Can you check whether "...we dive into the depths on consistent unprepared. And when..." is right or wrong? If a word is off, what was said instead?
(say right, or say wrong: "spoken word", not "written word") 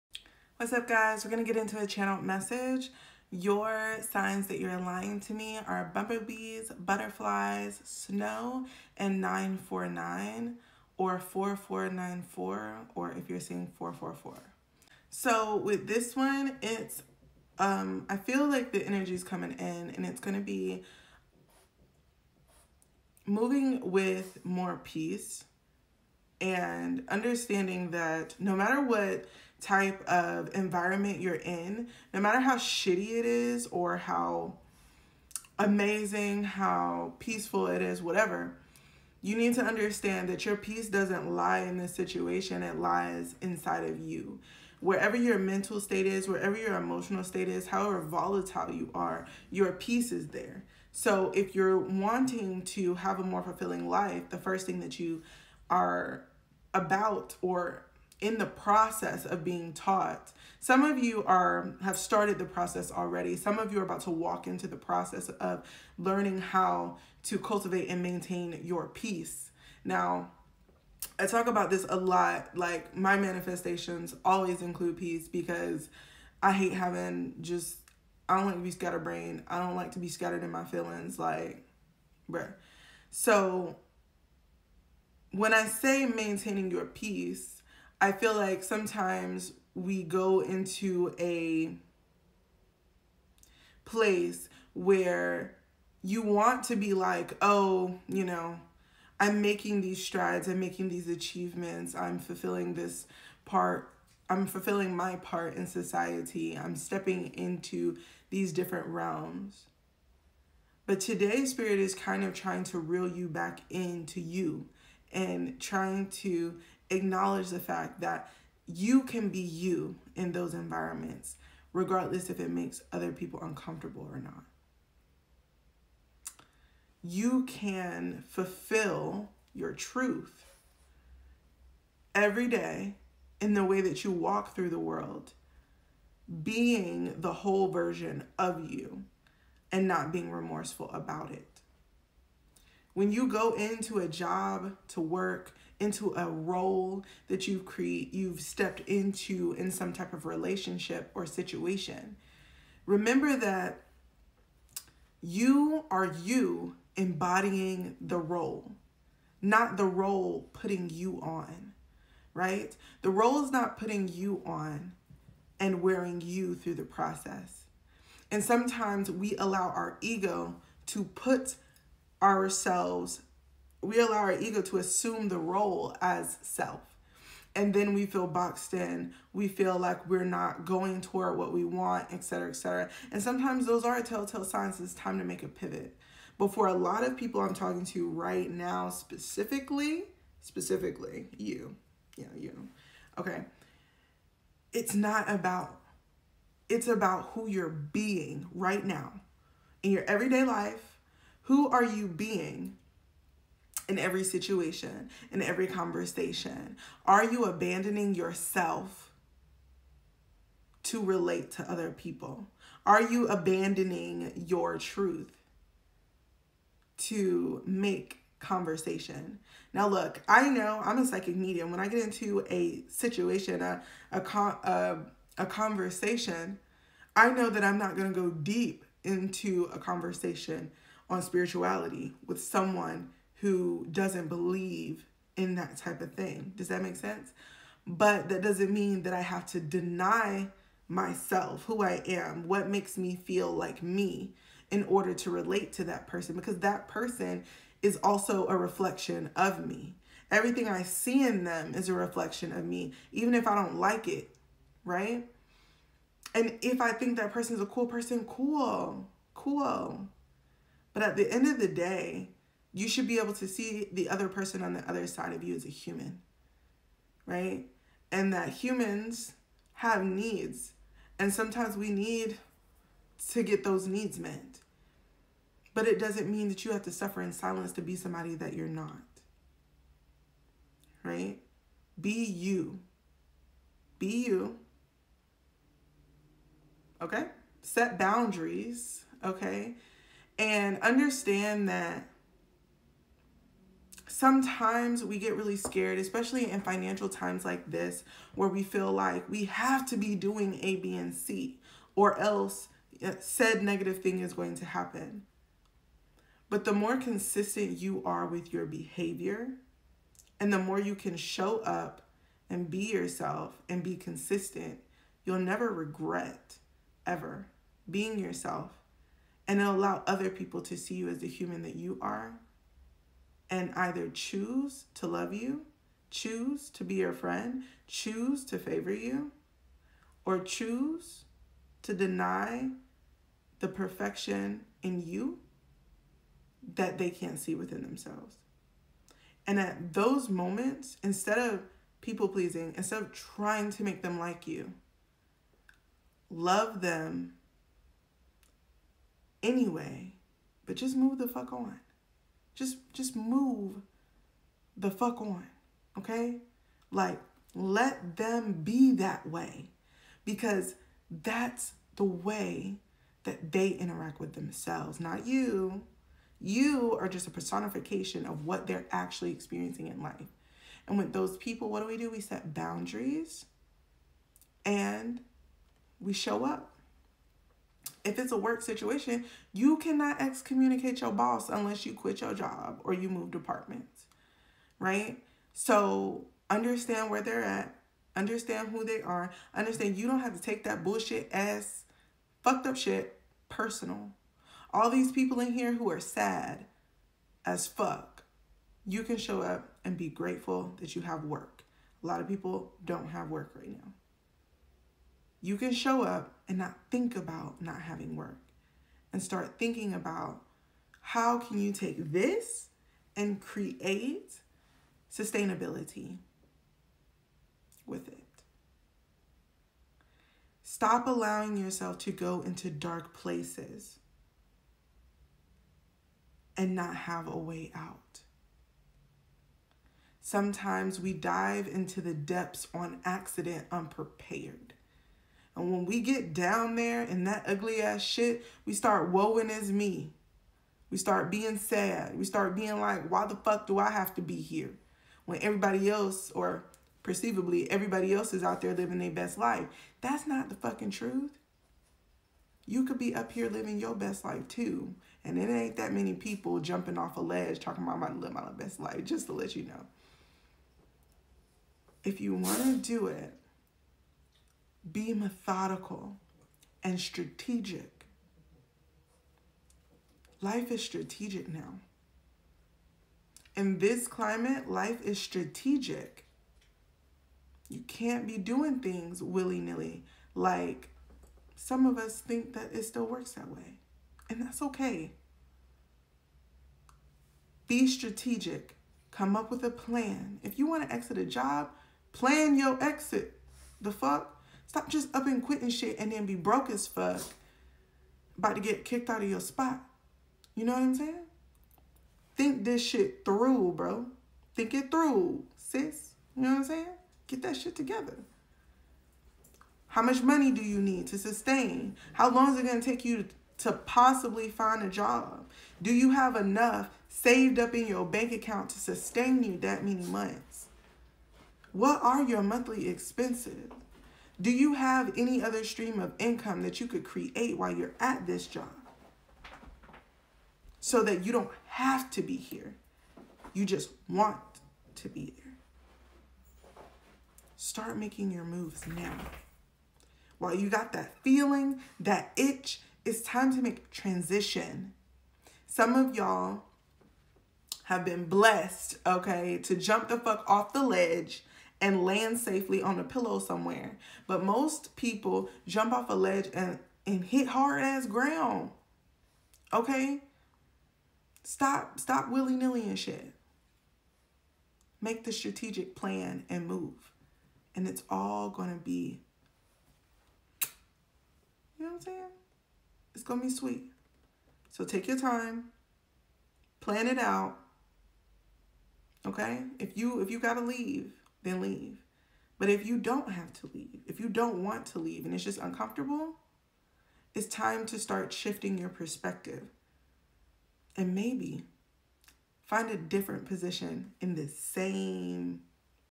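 wrong: "accident", not "consistent".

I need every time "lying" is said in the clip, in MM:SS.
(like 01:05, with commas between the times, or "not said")
00:04.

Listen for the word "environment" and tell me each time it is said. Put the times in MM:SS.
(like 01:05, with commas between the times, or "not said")
00:30, 02:00.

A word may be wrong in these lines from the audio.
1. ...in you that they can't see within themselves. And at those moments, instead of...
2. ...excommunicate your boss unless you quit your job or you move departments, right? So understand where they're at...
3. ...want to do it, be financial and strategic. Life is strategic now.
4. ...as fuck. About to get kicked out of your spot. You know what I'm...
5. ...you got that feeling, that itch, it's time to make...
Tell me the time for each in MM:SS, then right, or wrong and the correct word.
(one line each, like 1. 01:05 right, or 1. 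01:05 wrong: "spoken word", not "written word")
1. 05:34 right
2. 06:20 right
3. 07:42 wrong: "methodical", not "financial"
4. 08:16 right
5. 09:00 right.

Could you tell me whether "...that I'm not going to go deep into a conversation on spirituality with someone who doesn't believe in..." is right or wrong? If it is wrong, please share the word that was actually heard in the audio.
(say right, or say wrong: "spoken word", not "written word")
right.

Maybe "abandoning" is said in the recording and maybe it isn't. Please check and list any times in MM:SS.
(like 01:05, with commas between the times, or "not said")
03:27, 03:33.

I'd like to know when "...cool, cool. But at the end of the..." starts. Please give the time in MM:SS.
04:18.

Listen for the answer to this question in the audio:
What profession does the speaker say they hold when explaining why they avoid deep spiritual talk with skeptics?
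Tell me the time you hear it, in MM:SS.
03:41.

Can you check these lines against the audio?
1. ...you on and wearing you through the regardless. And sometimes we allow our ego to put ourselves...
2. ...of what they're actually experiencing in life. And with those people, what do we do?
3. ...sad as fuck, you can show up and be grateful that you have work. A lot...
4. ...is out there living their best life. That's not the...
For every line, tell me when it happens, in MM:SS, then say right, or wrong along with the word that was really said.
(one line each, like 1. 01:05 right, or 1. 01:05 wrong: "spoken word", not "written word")
1. 02:44 wrong: "process", not "regardless"
2. 06:08 right
3. 06:35 right
4. 07:28 right.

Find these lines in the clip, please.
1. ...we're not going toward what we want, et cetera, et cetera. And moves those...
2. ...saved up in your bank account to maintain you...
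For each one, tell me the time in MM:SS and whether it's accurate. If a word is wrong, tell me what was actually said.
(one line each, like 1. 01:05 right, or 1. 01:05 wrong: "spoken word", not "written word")
1. 03:00 wrong: "sometimes", not "moves"
2. 08:37 wrong: "sustain", not "maintain".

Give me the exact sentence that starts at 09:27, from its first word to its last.
And it's all gonna be, you know what I'm saying?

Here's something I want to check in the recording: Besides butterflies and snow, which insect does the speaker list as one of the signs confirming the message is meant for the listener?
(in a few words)
bumblebees.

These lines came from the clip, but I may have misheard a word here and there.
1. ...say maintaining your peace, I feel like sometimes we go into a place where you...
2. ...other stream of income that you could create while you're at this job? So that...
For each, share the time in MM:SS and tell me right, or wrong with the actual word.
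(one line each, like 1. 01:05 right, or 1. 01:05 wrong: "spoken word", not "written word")
1. 01:25 right
2. 08:45 right.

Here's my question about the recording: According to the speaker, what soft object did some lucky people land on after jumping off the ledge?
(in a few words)
a pillow.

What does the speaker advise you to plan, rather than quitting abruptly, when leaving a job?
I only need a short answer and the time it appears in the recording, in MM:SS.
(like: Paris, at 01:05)
your exit, at 08:12.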